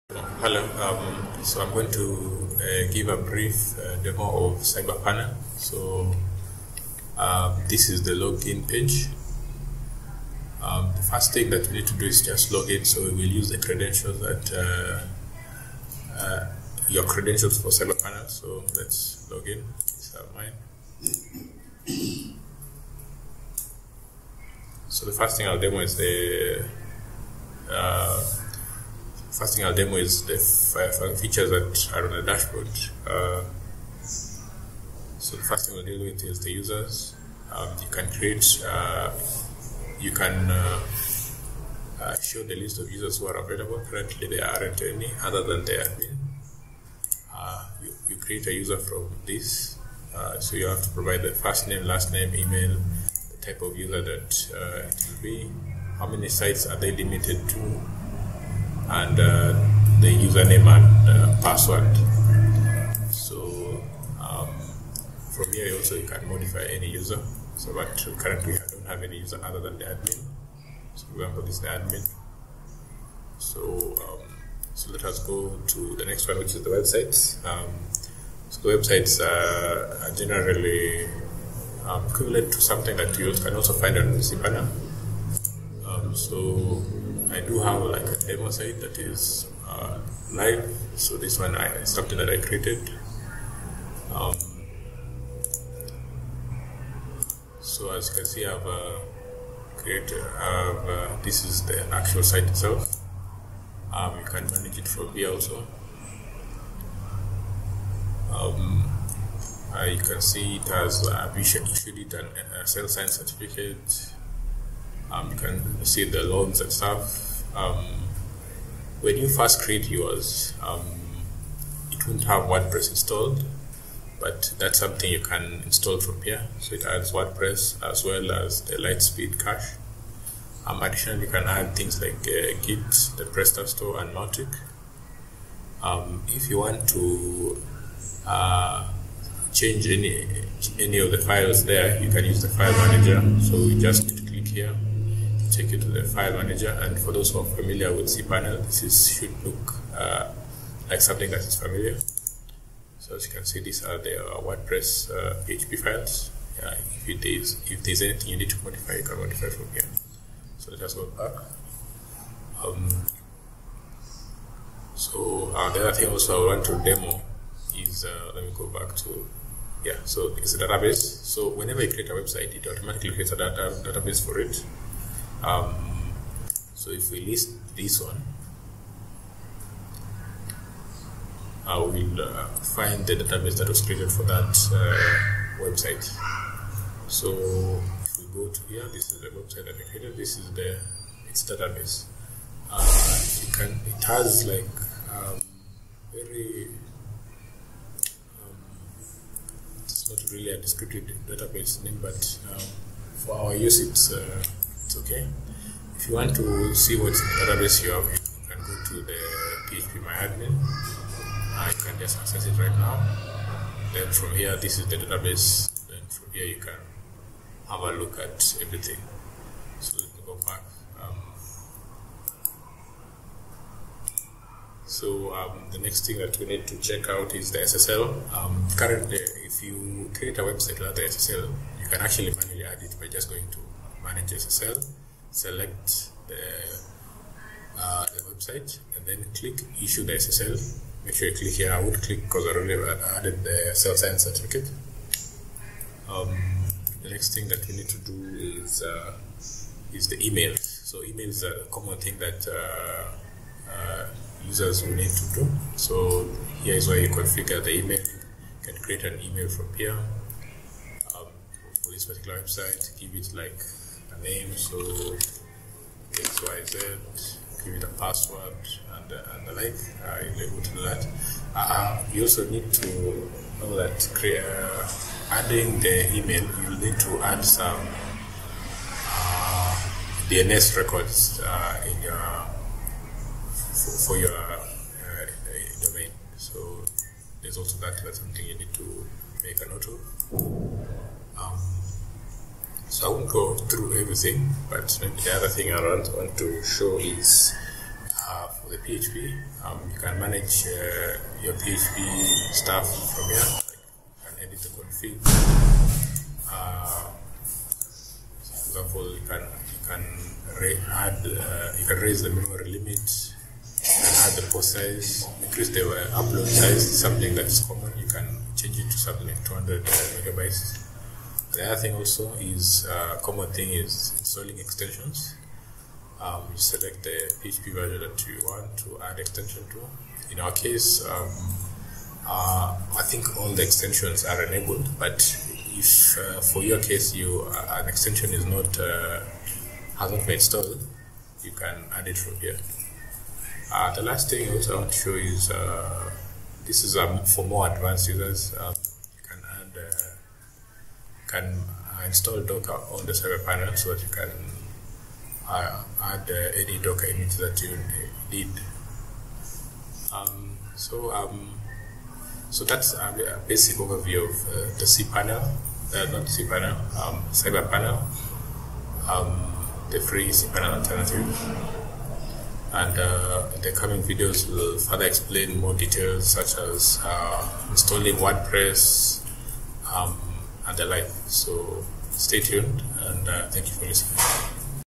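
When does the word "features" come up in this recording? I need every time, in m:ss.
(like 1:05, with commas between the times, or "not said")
0:31.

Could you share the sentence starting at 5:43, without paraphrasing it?
Uh, the last thing also I want to show is this is um, for more advanced users.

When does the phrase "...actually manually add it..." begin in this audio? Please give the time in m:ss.
3:52.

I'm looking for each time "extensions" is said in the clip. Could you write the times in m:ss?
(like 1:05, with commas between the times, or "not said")
5:24, 5:29, 5:33, 5:37.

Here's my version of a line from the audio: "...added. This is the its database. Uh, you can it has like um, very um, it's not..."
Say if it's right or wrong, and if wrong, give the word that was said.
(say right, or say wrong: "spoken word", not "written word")
wrong: "created", not "added".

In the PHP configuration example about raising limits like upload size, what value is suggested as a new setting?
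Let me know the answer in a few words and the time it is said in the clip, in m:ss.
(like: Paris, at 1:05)
200 megabytes, at 5:19.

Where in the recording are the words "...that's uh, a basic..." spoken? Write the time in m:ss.
6:02.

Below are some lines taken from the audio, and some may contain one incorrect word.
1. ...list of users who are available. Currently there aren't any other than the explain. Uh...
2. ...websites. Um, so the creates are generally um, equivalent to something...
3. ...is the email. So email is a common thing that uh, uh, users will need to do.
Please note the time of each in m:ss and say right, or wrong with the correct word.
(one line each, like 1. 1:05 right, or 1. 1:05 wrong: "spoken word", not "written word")
1. 0:42 wrong: "admin", not "explain"
2. 1:16 wrong: "websites", not "creates"
3. 4:09 right.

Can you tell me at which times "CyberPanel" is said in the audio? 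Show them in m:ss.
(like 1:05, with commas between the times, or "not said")
0:04, 0:17, 5:53, 6:07.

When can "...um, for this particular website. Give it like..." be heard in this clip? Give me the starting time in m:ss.
4:21.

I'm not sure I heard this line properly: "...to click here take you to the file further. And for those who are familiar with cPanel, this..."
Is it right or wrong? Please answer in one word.
wrong.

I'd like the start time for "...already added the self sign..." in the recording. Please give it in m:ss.
4:02.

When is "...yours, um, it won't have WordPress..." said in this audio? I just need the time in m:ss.
1:59.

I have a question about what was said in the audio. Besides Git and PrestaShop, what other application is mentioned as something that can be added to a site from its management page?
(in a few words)
Mautic.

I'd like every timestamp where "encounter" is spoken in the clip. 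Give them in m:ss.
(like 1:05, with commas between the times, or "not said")
not said.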